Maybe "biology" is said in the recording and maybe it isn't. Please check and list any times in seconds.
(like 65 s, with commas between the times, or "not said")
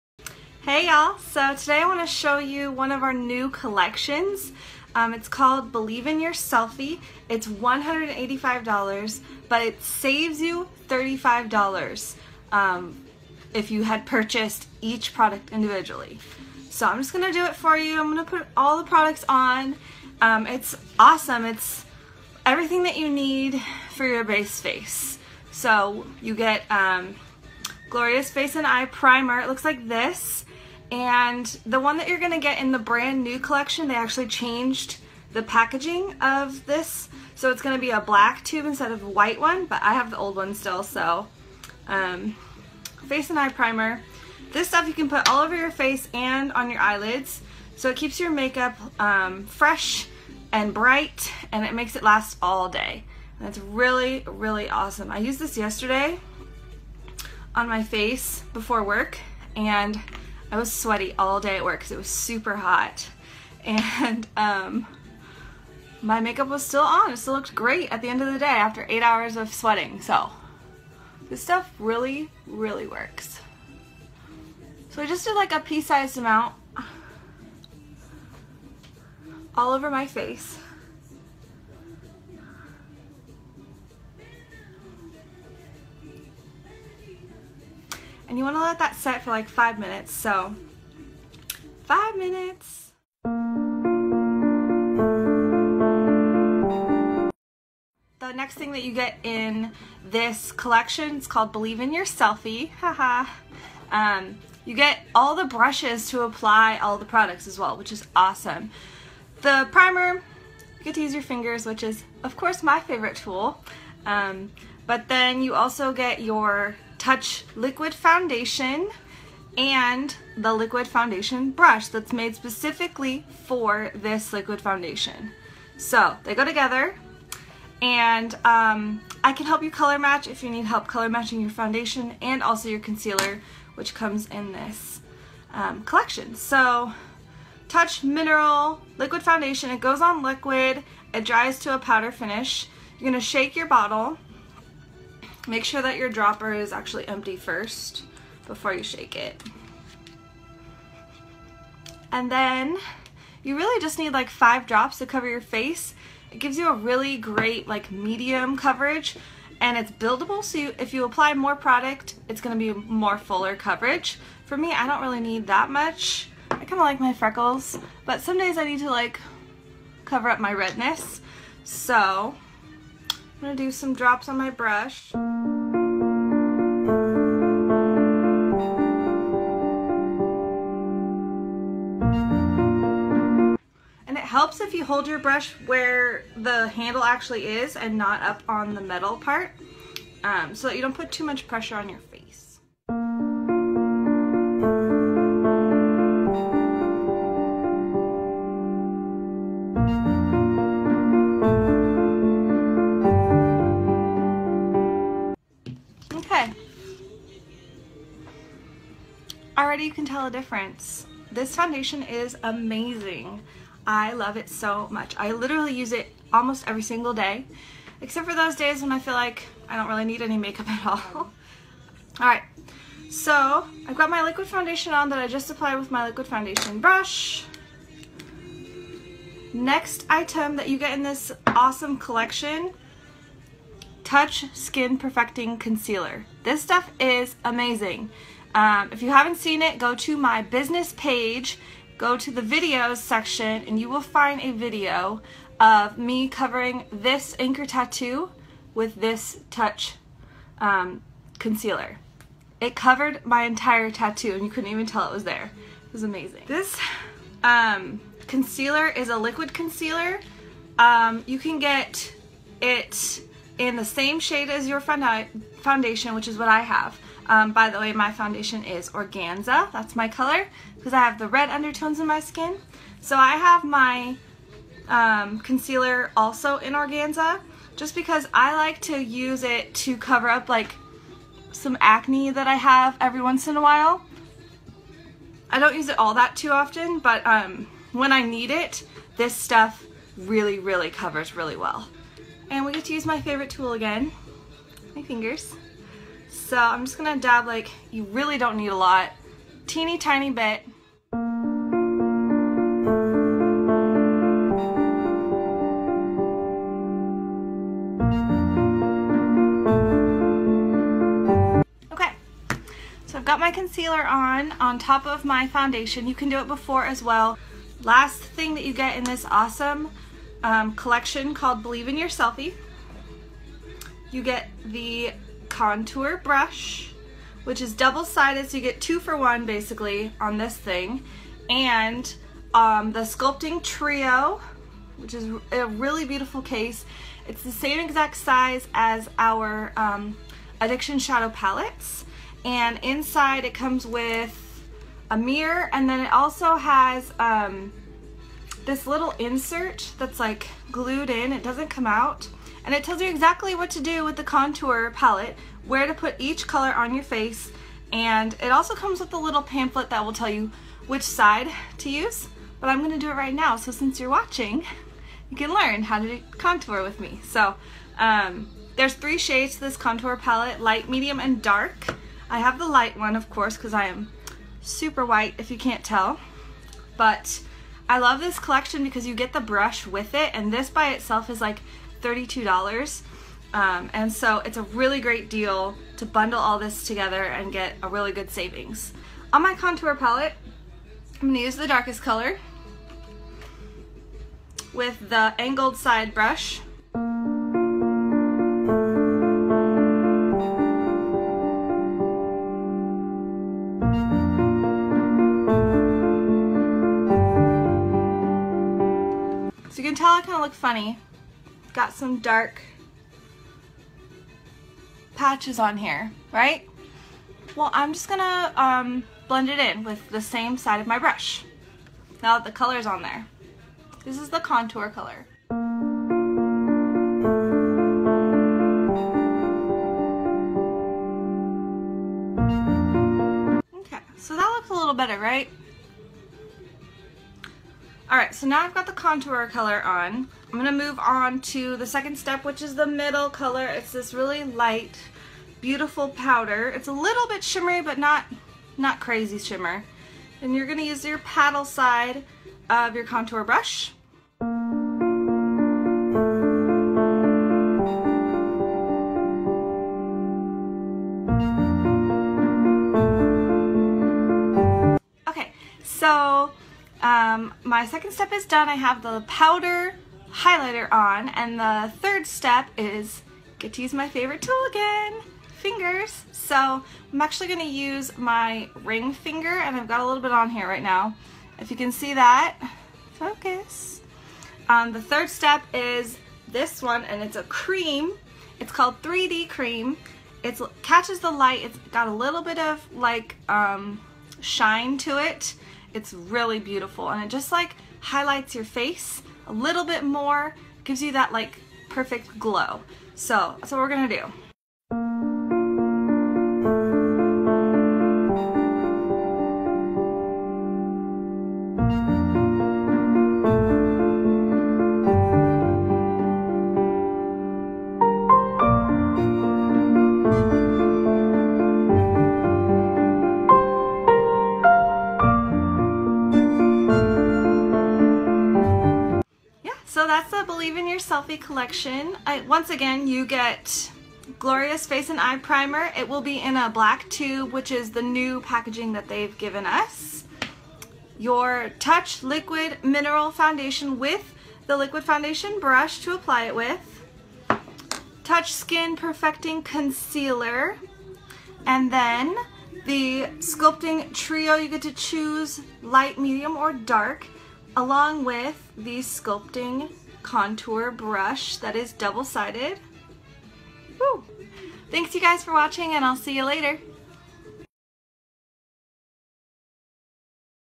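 not said.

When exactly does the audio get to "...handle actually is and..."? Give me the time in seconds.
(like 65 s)
186 s.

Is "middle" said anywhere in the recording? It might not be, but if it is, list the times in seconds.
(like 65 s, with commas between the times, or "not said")
442 s.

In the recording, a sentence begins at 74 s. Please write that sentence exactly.
So I just did like a pea-sized amount all over my face.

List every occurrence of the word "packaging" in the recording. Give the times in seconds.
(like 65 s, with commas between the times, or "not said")
35 s, 538 s.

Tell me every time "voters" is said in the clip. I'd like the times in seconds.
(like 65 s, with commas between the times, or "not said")
not said.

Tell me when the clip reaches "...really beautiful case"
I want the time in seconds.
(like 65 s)
335 s.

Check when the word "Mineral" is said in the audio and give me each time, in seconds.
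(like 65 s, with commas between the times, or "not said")
138 s, 542 s.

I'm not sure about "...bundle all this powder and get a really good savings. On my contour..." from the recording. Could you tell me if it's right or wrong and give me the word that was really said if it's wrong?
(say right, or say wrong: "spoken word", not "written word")
wrong: "together", not "powder".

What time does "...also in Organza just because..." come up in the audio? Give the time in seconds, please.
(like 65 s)
276 s.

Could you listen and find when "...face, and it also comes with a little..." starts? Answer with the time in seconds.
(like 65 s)
357 s.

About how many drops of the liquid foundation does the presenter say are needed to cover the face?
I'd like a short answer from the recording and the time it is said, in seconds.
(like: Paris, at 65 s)
5, at 154 s.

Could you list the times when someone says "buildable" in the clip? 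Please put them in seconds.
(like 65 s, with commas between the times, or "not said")
159 s.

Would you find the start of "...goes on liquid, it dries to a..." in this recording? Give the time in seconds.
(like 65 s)
139 s.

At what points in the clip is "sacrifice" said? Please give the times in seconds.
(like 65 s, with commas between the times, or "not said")
not said.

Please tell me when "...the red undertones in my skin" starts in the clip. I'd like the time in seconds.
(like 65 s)
271 s.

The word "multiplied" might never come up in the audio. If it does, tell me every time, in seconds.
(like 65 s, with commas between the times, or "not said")
not said.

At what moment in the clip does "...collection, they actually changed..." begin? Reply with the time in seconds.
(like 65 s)
33 s.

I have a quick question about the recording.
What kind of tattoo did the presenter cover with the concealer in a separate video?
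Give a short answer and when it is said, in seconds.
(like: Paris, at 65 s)
Anchor, at 247 s.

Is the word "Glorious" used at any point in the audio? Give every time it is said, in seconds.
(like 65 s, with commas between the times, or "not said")
27 s, 534 s.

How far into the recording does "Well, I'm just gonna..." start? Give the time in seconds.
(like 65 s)
417 s.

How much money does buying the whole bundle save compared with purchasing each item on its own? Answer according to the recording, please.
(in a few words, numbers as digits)
$35.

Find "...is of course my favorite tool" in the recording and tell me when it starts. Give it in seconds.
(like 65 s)
111 s.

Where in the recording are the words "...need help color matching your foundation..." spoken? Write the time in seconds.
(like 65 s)
130 s.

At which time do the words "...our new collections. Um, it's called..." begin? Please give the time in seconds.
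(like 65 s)
3 s.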